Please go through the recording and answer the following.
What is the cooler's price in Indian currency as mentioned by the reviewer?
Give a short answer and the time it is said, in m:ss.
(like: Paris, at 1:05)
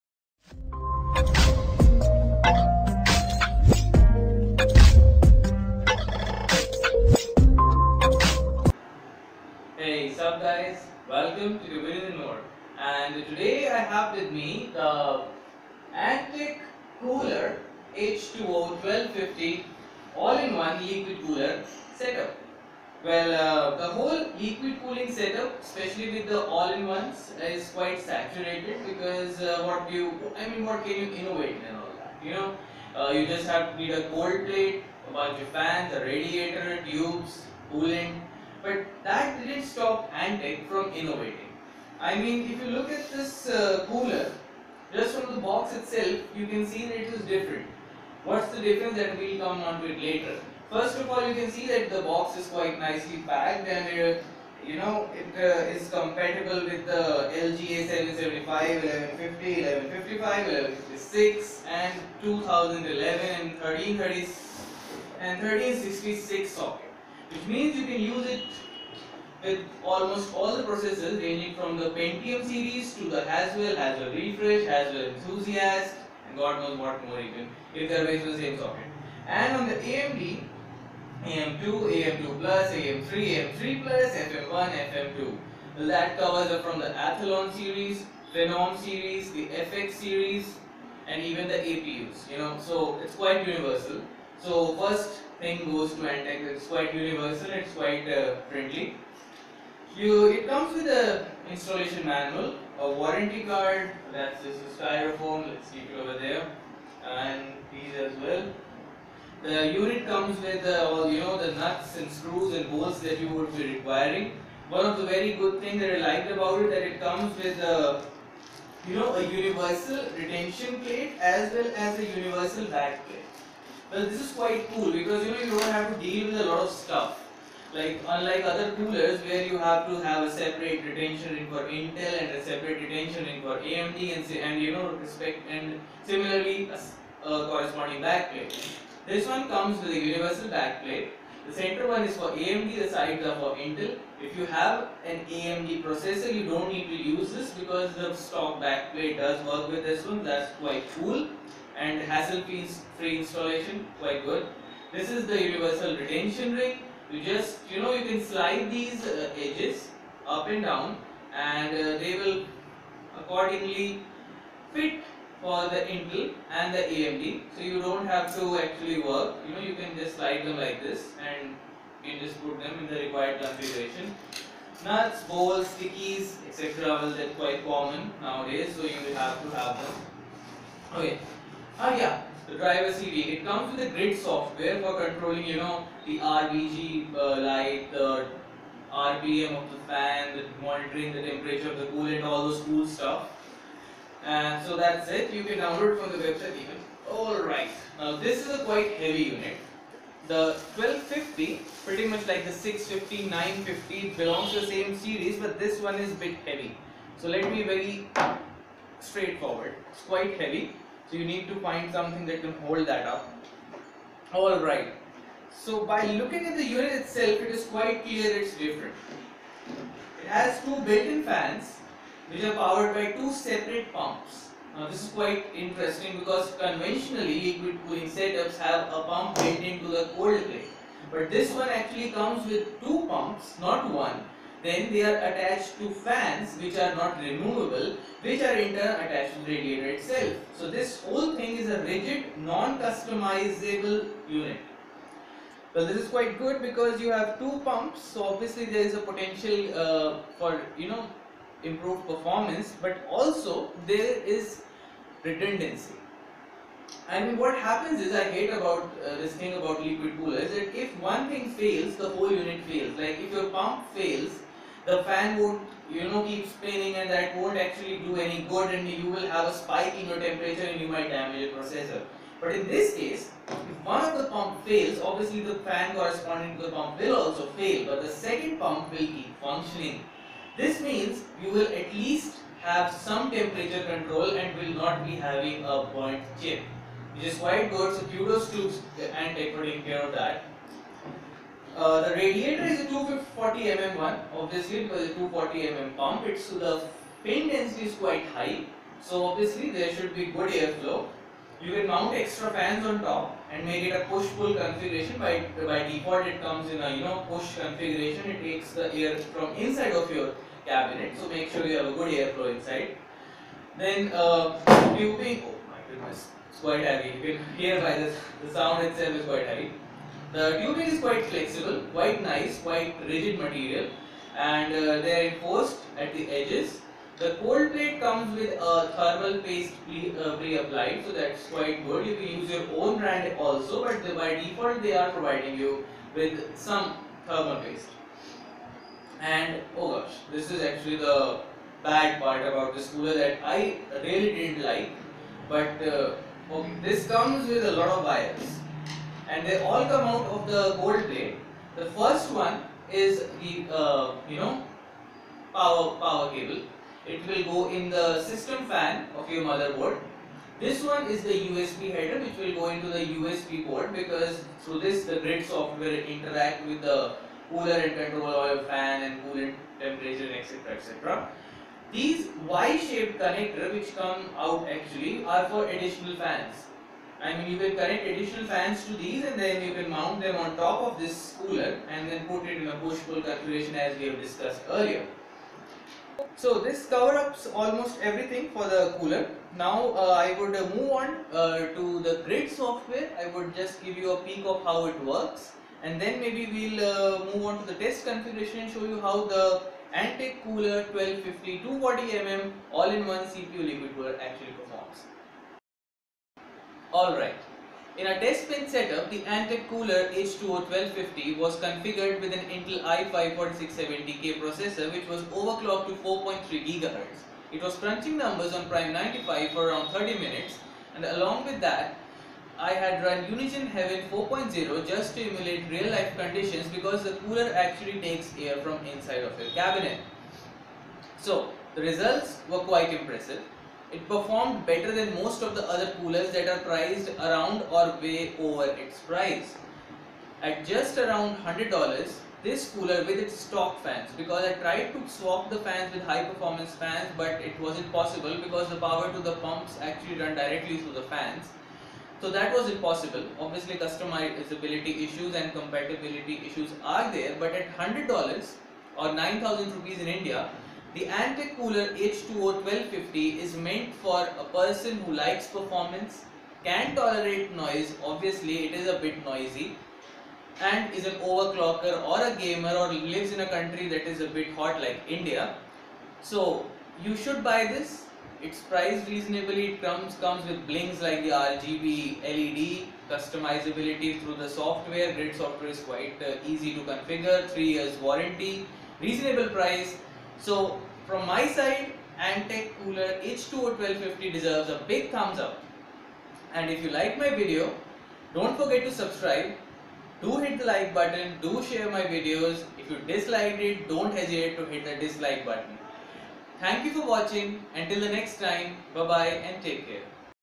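9000 rupees, at 7:39.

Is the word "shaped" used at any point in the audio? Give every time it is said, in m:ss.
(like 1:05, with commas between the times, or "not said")
6:12.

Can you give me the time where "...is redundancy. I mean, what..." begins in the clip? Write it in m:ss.
4:14.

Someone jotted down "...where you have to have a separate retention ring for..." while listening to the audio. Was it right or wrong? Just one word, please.
right.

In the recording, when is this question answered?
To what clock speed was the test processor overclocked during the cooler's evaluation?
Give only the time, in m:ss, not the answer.
6:55.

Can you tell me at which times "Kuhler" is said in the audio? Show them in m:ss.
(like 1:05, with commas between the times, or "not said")
0:17, 6:40, 6:49, 7:41, 8:12.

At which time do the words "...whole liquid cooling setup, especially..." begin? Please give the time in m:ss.
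0:23.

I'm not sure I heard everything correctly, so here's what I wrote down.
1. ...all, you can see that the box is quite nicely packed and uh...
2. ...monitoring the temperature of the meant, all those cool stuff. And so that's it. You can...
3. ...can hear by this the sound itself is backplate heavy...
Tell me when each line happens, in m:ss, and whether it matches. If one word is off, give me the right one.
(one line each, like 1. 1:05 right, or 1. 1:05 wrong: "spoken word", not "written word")
1. 0:51 right
2. 3:10 wrong: "coolant", not "meant"
3. 5:17 wrong: "quite", not "backplate".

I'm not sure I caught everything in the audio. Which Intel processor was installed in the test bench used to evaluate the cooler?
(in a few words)
i5-4670K.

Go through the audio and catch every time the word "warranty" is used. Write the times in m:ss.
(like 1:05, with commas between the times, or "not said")
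1:42, 8:07.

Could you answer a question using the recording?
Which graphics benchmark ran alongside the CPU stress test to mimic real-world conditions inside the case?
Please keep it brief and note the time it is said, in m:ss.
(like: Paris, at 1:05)
Unigine Heaven 4.0, at 7:03.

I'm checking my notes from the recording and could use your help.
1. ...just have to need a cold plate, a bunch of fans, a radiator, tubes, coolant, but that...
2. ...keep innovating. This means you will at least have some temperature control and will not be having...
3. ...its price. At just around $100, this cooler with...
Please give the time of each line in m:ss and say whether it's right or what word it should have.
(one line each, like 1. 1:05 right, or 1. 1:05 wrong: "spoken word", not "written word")
1. 0:33 right
2. 4:39 wrong: "functioning", not "innovating"
3. 7:18 right.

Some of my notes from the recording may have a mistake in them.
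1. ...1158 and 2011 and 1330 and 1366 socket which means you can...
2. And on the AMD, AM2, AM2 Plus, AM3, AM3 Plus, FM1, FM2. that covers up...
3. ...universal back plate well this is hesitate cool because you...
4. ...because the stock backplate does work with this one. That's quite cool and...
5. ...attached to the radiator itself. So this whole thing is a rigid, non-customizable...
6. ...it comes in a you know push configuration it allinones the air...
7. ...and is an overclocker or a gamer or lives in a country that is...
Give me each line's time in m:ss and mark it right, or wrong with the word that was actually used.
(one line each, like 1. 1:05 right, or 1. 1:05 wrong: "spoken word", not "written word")
1. 1:00 wrong: "1156", not "1158"
2. 1:19 right
3. 2:02 wrong: "quite", not "hesitate"
4. 2:27 right
5. 3:59 right
6. 5:06 wrong: "takes", not "allinones"
7. 7:50 right.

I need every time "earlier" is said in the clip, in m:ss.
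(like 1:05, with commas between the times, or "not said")
6:24.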